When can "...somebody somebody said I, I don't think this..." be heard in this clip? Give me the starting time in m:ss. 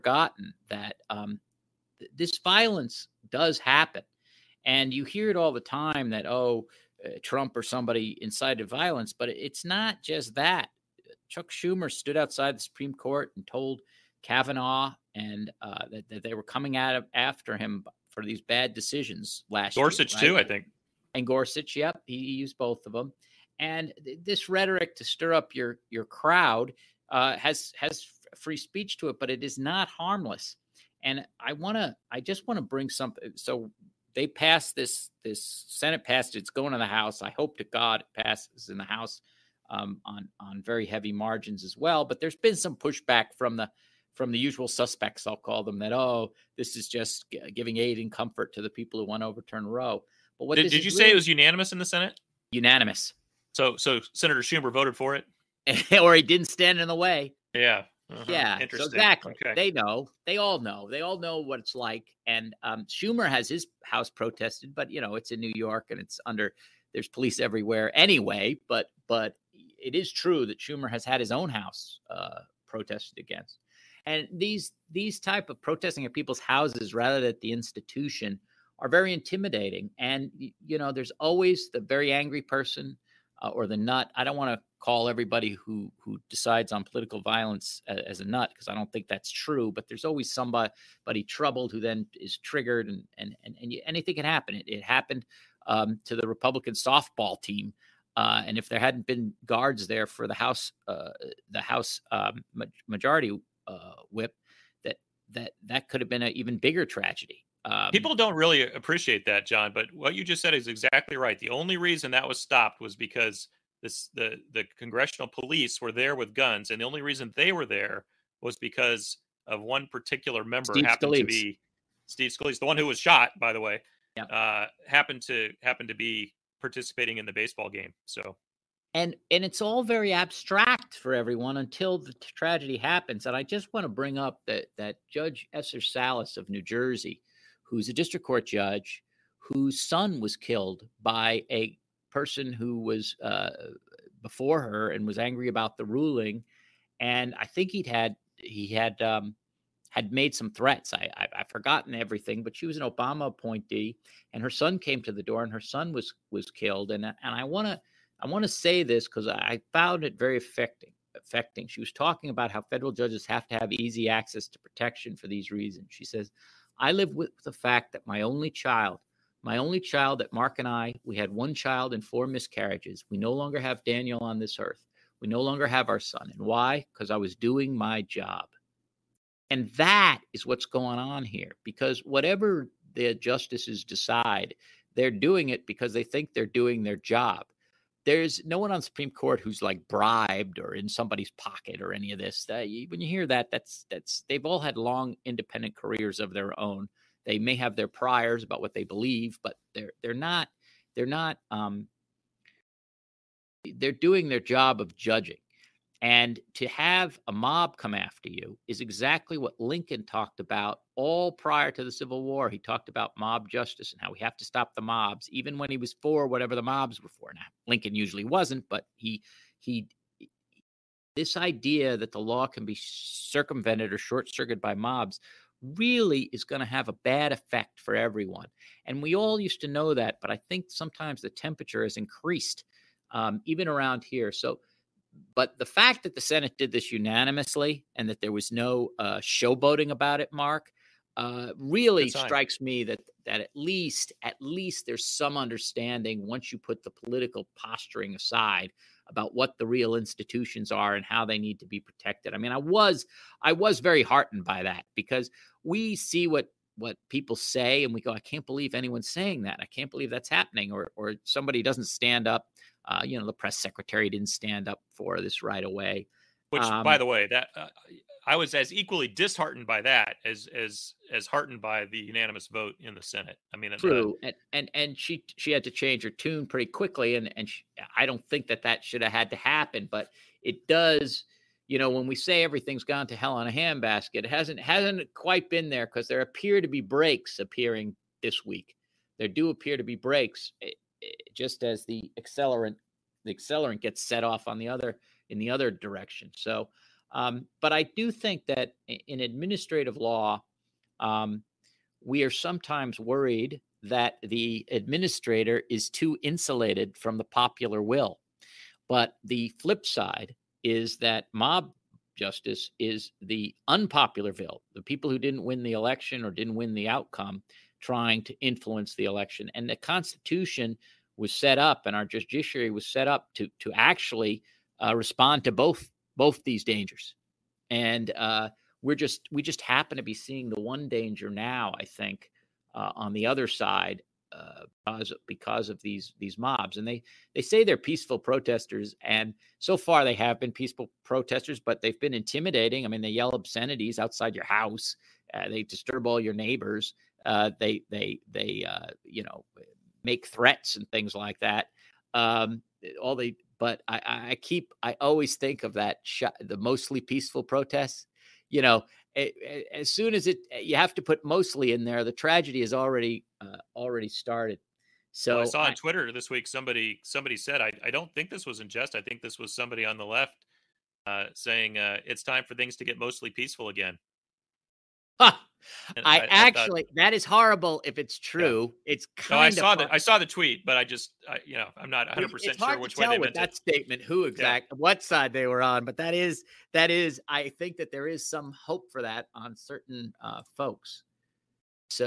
6:06.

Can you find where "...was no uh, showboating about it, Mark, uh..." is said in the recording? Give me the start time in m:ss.
3:58.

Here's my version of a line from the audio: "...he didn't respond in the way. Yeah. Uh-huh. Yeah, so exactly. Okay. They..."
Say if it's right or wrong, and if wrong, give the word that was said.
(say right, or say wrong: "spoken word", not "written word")
wrong: "stand", not "respond".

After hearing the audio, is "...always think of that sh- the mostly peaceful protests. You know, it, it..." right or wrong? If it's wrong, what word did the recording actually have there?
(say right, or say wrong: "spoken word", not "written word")
right.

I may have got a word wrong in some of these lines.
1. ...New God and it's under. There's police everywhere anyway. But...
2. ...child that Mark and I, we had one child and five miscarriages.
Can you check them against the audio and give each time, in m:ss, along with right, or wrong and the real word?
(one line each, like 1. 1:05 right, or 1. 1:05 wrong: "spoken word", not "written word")
1. 1:05 wrong: "York", not "God"
2. 2:49 wrong: "four", not "five".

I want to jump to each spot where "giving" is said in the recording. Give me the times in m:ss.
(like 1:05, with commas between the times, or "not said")
0:47.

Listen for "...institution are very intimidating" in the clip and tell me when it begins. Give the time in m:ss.
1:17.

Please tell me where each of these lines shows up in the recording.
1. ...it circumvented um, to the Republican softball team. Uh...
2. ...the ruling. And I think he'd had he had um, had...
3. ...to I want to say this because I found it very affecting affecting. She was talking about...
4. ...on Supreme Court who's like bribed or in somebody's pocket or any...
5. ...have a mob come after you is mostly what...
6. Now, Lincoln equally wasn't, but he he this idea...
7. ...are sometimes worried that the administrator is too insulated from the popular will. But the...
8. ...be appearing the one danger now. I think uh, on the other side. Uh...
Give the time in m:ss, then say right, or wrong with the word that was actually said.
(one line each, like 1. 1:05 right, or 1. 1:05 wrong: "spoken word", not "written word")
1. 1:34 wrong: "happened", not "circumvented"
2. 2:25 right
3. 2:37 right
4. 3:08 right
5. 3:26 wrong: "exactly", not "mostly"
6. 3:37 wrong: "usually", not "equally"
7. 5:02 right
8. 5:30 wrong: "seeing", not "appearing".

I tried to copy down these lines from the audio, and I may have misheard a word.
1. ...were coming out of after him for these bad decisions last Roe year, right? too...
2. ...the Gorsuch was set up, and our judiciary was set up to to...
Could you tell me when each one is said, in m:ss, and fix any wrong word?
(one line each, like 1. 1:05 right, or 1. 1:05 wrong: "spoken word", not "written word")
1. 0:16 wrong: "Gorsuch", not "Roe"
2. 5:19 wrong: "Constitution", not "Gorsuch".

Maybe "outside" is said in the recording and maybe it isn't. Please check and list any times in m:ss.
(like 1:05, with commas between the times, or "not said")
0:12, 5:43.